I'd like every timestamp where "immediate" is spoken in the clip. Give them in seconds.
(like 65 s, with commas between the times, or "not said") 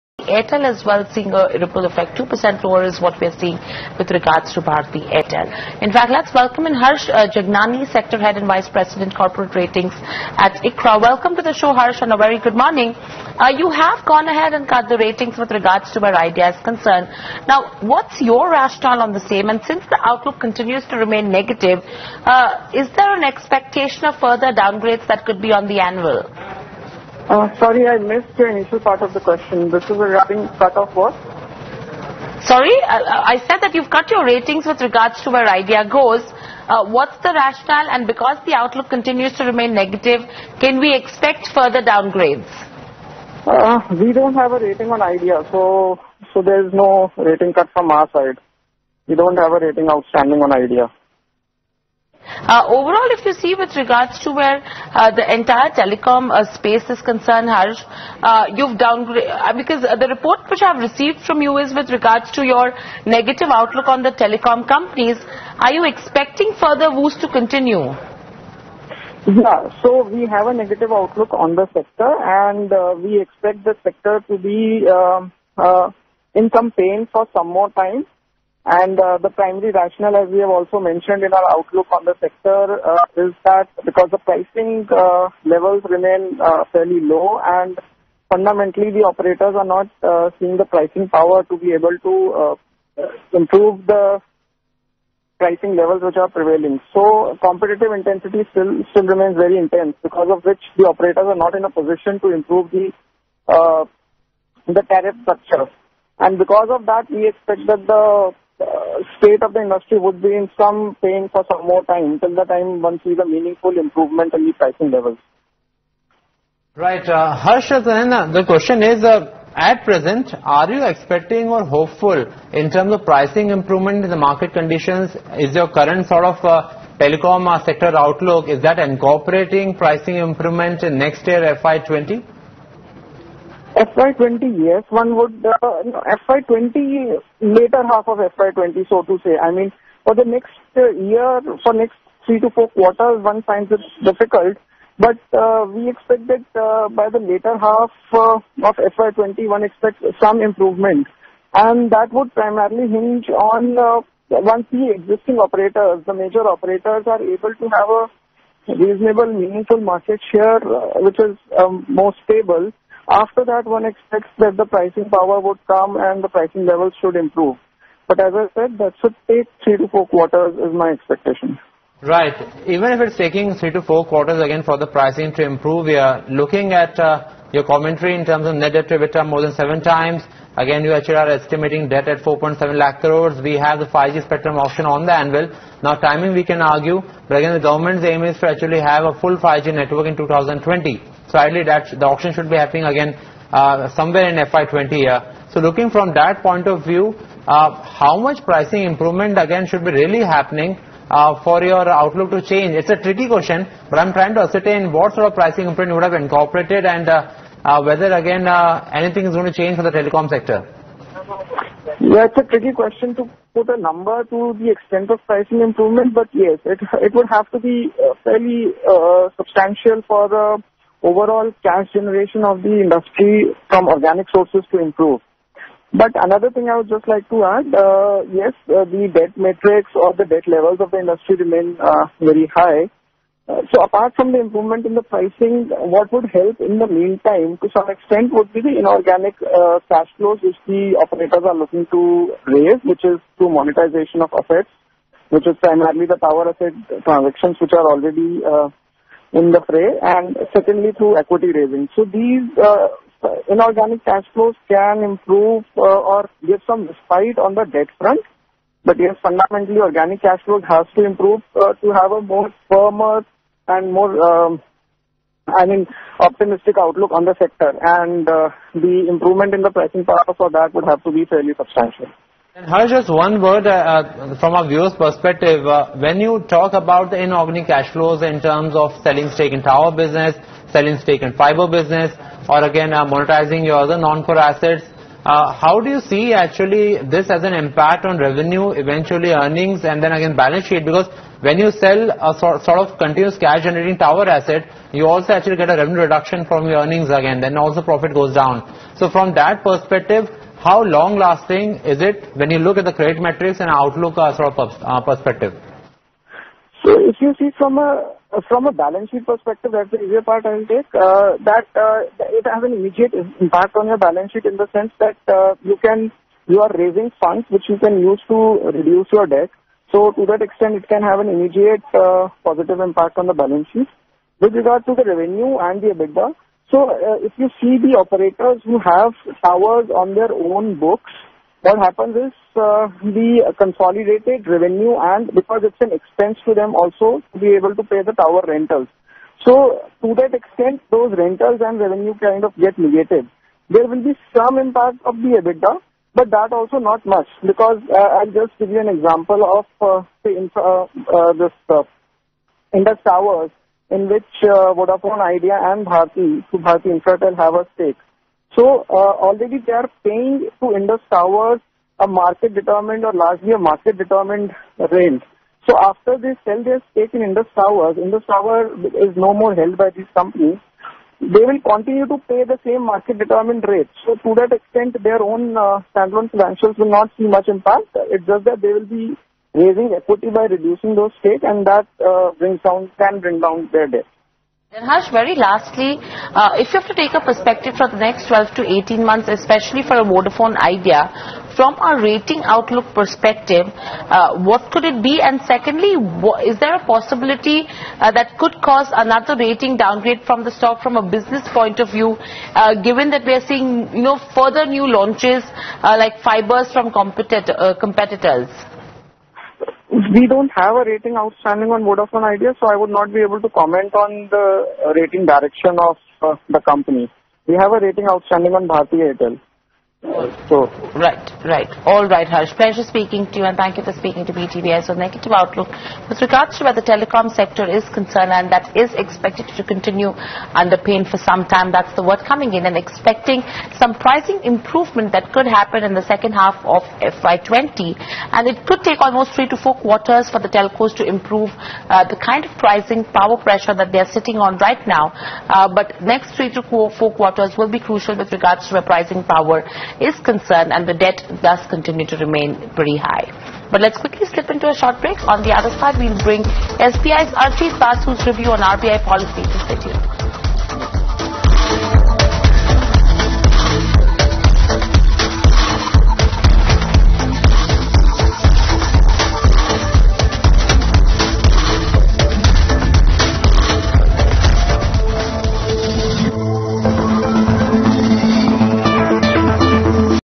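312 s, 321 s.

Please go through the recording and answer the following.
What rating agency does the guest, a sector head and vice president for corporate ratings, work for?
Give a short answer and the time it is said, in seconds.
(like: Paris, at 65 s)
ICRA, at 10 s.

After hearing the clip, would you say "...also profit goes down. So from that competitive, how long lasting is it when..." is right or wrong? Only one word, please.
wrong.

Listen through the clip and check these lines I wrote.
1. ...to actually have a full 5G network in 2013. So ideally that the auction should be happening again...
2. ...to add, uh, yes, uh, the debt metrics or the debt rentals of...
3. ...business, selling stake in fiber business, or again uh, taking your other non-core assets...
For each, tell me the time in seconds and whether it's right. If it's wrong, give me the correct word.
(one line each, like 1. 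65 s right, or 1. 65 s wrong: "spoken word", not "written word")
1. 188 s wrong: "2020", not "2013"
2. 227 s wrong: "levels", not "rentals"
3. 279 s wrong: "monetizing", not "taking".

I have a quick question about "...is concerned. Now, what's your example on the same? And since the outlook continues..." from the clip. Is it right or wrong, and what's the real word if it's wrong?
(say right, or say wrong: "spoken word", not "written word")
wrong: "rationale", not "example".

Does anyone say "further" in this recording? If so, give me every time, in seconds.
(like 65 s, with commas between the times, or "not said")
24 s, 41 s, 66 s, 404 s.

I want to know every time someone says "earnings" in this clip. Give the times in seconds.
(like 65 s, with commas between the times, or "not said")
289 s, 296 s.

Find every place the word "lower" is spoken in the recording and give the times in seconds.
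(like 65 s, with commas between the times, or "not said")
2 s.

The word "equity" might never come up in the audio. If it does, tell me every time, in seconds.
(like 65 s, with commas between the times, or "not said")
251 s, 379 s.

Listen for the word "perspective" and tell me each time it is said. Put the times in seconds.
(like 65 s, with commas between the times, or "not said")
274 s, 299 s, 305 s, 309 s, 387 s, 392 s.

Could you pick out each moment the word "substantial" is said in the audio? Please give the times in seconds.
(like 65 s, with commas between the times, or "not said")
219 s, 271 s.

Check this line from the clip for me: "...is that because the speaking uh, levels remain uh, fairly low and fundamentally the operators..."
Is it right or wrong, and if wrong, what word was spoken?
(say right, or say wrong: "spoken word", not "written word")
wrong: "pricing", not "speaking".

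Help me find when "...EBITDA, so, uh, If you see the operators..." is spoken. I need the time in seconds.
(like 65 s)
325 s.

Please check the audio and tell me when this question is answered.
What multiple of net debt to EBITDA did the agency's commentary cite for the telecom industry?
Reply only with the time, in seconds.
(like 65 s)
179 s.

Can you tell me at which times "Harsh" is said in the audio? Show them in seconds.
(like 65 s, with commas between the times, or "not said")
6 s, 11 s, 57 s, 117 s, 272 s, 384 s, 422 s.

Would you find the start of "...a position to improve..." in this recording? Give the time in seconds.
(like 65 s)
101 s.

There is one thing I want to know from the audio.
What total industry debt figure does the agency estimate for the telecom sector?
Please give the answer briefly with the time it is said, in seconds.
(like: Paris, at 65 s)
4.7 lakh crores, at 182 s.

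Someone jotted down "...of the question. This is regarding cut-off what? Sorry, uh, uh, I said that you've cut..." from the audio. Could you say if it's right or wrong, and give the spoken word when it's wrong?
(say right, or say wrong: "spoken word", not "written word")
right.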